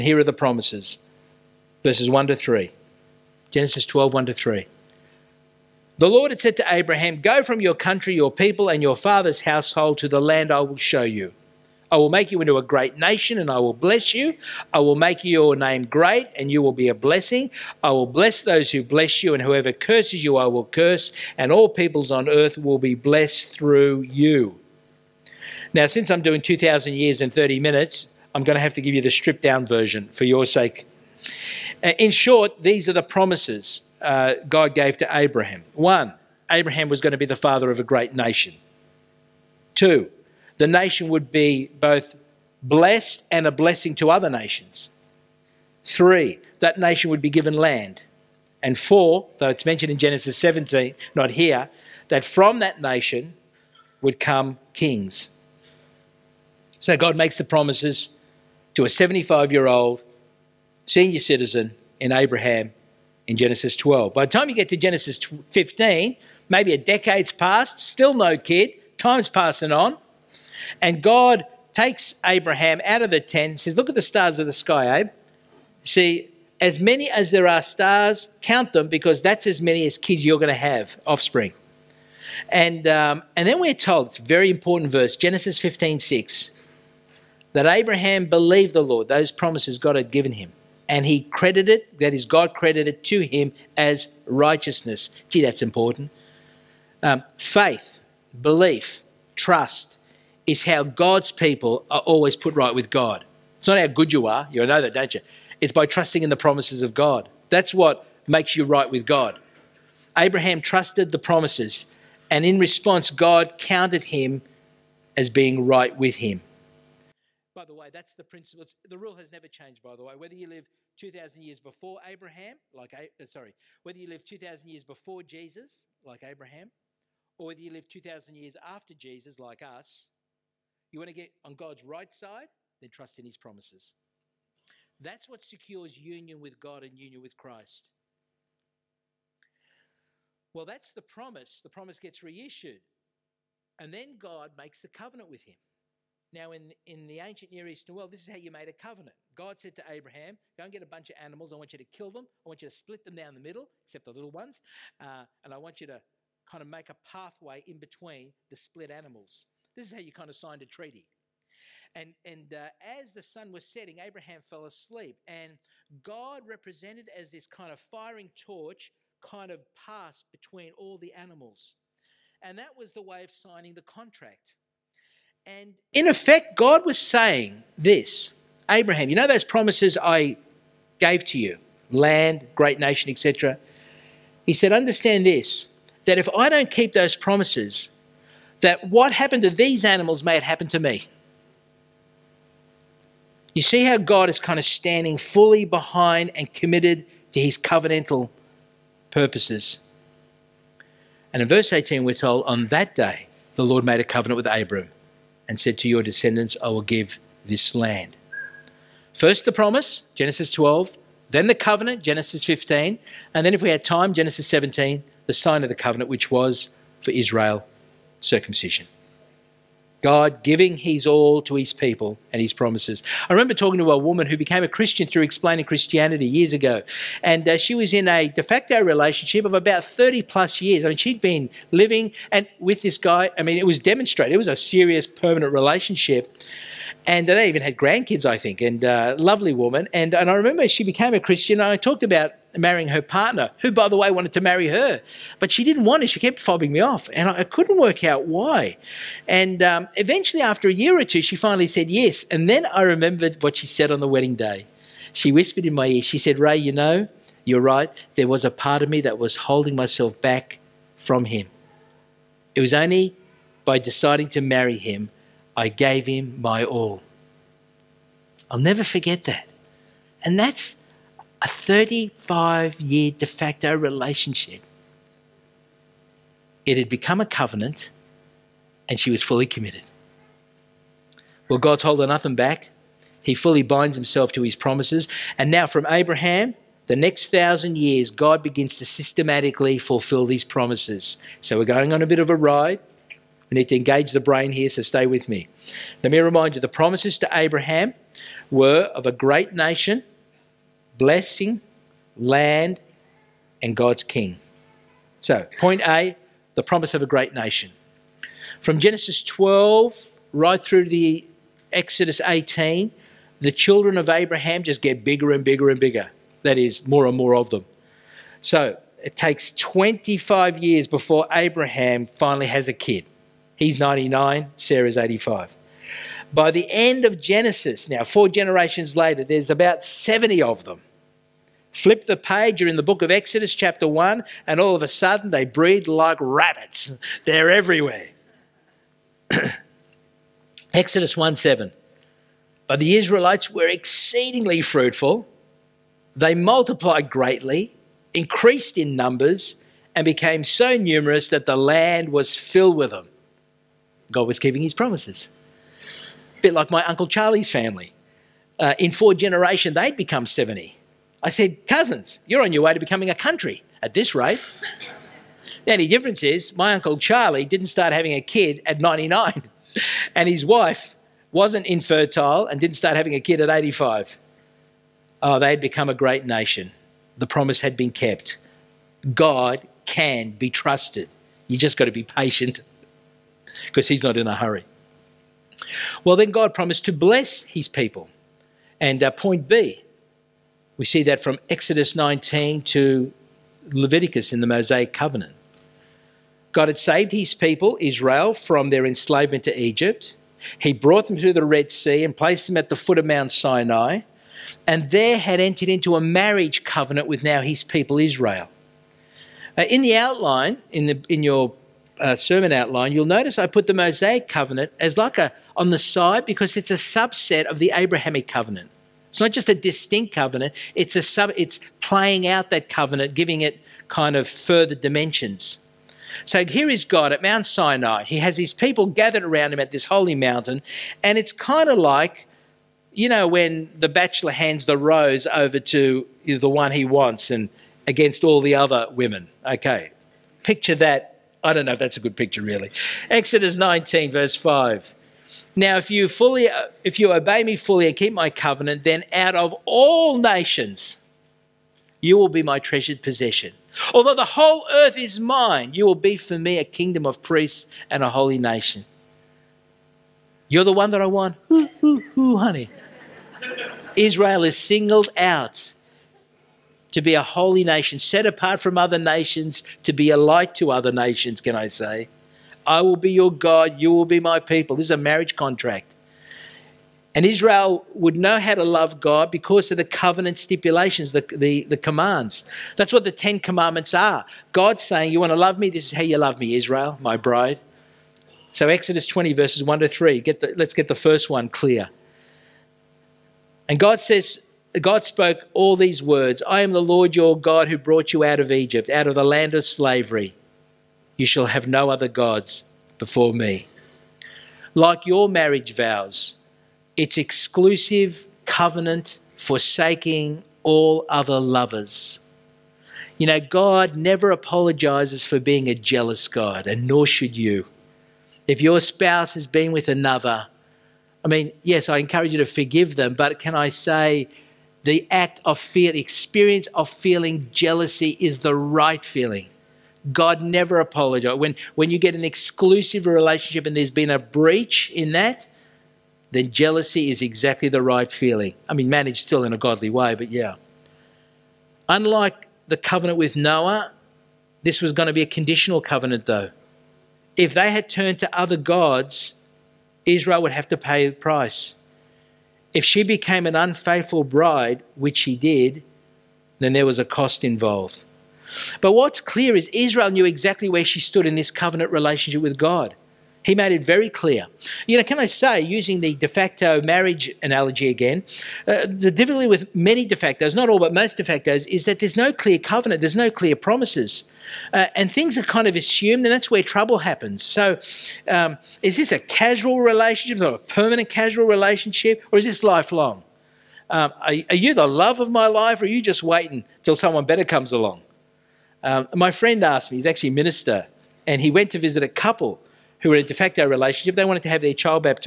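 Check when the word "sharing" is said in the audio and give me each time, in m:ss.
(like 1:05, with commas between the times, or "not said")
not said.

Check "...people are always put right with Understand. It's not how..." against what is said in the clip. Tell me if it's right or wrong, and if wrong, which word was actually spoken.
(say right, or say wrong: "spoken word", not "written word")
wrong: "God", not "Understand".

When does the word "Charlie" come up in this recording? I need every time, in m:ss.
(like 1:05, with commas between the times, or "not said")
5:57, 6:06.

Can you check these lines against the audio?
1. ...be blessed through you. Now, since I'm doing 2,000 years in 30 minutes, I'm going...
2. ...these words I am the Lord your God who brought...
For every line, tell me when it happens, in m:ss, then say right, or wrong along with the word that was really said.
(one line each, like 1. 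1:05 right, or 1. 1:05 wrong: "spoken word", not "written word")
1. 0:22 right
2. 8:15 right.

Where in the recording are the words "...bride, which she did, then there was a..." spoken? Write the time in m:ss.
9:14.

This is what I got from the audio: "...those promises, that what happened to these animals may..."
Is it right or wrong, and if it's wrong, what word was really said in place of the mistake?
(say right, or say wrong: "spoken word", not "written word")
right.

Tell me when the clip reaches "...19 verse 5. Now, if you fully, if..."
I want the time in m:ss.
7:23.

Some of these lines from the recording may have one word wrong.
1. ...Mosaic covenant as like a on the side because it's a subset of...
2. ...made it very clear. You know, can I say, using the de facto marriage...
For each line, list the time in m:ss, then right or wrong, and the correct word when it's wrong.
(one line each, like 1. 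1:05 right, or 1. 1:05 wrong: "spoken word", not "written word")
1. 6:53 right
2. 9:23 right.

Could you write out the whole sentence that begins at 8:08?
So, Exodus 20, verses 1 to 3, get the, let's get the first one clear.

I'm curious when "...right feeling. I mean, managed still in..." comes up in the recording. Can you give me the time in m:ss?
8:57.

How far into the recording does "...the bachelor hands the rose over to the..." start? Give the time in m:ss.
7:13.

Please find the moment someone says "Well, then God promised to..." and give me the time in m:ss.
6:26.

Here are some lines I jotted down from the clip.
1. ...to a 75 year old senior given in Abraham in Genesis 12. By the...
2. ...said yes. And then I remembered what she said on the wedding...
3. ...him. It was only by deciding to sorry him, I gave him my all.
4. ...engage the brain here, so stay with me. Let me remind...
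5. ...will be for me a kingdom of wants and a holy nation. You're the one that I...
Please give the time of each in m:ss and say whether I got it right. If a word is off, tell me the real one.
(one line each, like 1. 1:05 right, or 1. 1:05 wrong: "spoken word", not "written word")
1. 0:58 wrong: "citizen", not "given"
2. 4:11 right
3. 4:21 wrong: "marry", not "sorry"
4. 4:53 right
5. 7:35 wrong: "priests", not "wants".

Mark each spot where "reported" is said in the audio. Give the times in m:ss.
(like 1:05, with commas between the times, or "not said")
not said.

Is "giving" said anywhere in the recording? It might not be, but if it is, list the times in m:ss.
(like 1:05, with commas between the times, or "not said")
3:40, 7:03.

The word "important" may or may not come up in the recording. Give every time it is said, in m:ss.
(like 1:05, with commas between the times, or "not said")
1:24, 1:35.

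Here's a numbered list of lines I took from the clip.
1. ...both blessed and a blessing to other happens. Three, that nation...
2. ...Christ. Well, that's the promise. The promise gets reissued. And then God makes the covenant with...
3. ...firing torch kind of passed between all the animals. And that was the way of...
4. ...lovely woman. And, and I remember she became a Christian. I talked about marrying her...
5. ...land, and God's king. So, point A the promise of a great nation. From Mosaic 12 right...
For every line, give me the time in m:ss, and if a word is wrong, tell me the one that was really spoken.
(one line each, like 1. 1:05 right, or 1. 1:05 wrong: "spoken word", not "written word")
1. 0:41 wrong: "nations", not "happens"
2. 2:17 right
3. 2:47 right
4. 3:59 right
5. 5:02 wrong: "Genesis", not "Mosaic".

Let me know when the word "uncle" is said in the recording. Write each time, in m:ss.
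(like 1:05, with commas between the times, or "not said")
5:56, 6:06.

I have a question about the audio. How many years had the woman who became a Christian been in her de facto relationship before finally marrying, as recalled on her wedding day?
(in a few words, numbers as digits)
35.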